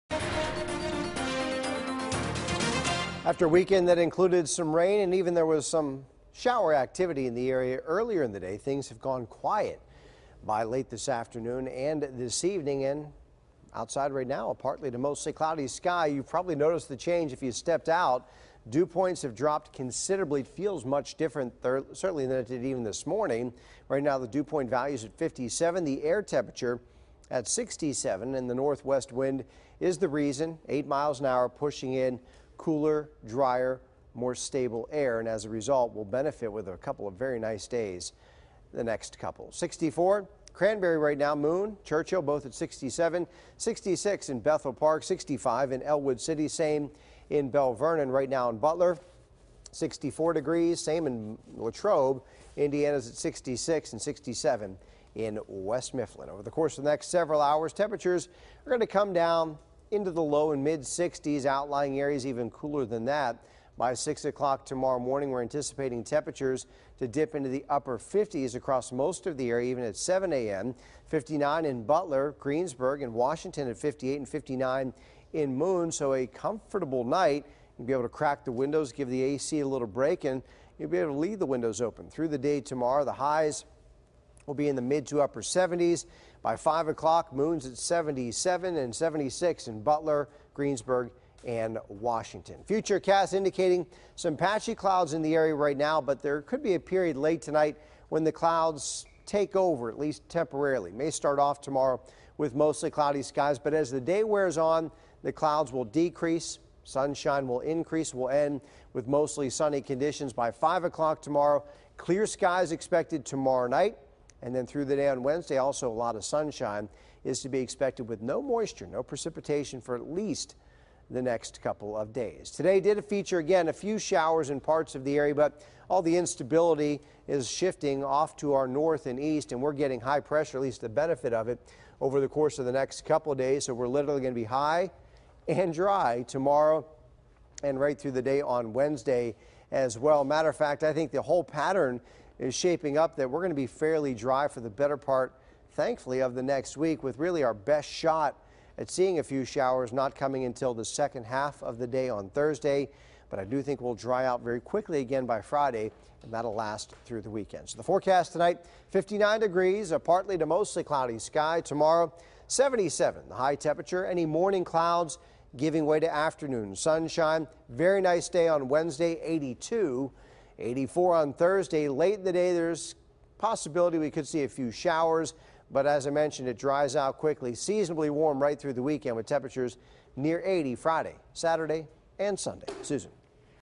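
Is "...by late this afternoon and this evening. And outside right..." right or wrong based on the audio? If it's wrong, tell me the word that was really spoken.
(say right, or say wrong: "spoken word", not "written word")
right.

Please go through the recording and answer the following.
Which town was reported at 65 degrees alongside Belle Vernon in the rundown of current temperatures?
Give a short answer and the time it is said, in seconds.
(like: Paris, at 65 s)
Ellwood City, at 45 s.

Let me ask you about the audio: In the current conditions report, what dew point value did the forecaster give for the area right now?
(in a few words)
57.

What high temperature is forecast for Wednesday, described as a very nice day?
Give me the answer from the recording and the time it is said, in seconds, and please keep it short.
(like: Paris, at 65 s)
82, at 167 s.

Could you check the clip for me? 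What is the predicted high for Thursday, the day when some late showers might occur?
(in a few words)
84.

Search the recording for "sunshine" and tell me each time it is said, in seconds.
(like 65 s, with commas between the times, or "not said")
106 s, 116 s, 166 s.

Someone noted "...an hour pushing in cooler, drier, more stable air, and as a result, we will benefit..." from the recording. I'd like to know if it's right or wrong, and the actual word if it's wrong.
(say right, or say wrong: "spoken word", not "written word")
right.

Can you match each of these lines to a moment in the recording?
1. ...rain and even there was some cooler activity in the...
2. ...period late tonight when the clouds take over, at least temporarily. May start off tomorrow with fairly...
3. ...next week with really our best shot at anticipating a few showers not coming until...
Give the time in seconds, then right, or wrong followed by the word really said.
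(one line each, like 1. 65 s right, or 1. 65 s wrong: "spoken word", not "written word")
1. 4 s wrong: "shower", not "cooler"
2. 96 s wrong: "mostly", not "fairly"
3. 146 s wrong: "seeing", not "anticipating".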